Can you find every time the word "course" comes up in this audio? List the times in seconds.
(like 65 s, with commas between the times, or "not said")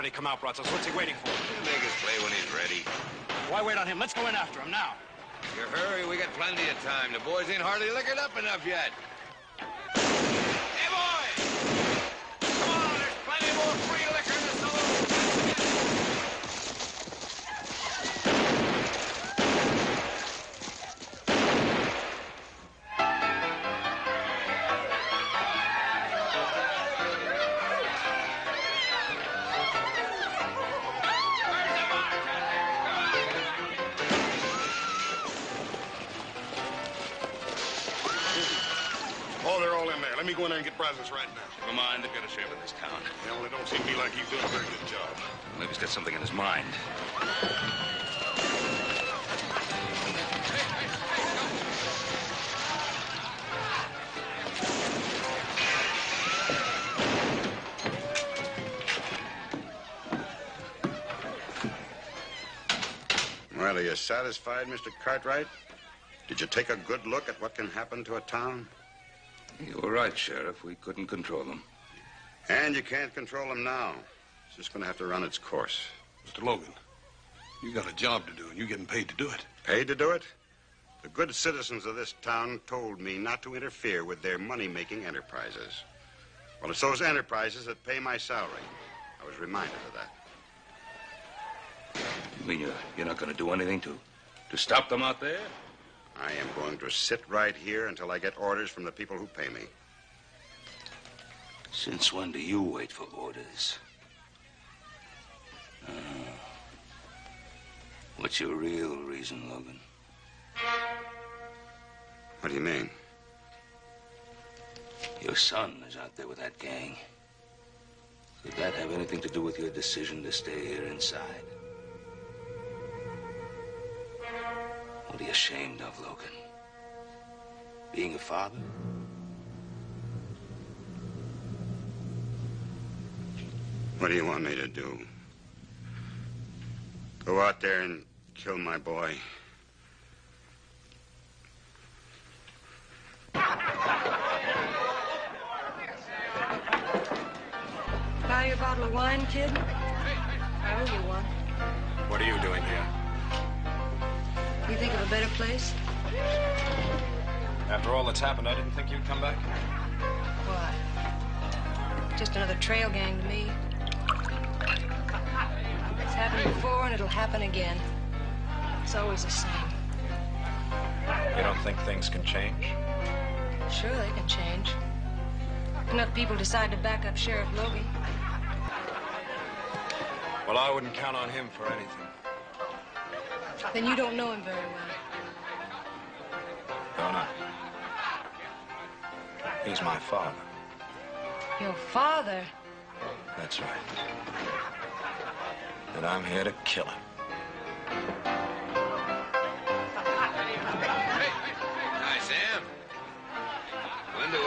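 75 s.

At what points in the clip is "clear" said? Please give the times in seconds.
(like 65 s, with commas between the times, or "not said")
not said.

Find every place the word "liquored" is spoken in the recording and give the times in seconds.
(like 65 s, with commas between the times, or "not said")
7 s.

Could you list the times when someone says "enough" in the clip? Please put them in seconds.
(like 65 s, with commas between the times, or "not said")
8 s, 175 s.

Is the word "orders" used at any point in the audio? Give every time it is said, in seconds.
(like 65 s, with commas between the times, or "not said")
98 s, 103 s.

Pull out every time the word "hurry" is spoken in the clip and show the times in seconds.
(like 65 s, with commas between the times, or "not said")
5 s.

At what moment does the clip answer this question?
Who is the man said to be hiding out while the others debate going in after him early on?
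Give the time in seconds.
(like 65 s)
0 s.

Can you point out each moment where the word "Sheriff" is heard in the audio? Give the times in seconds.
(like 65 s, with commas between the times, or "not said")
70 s, 177 s.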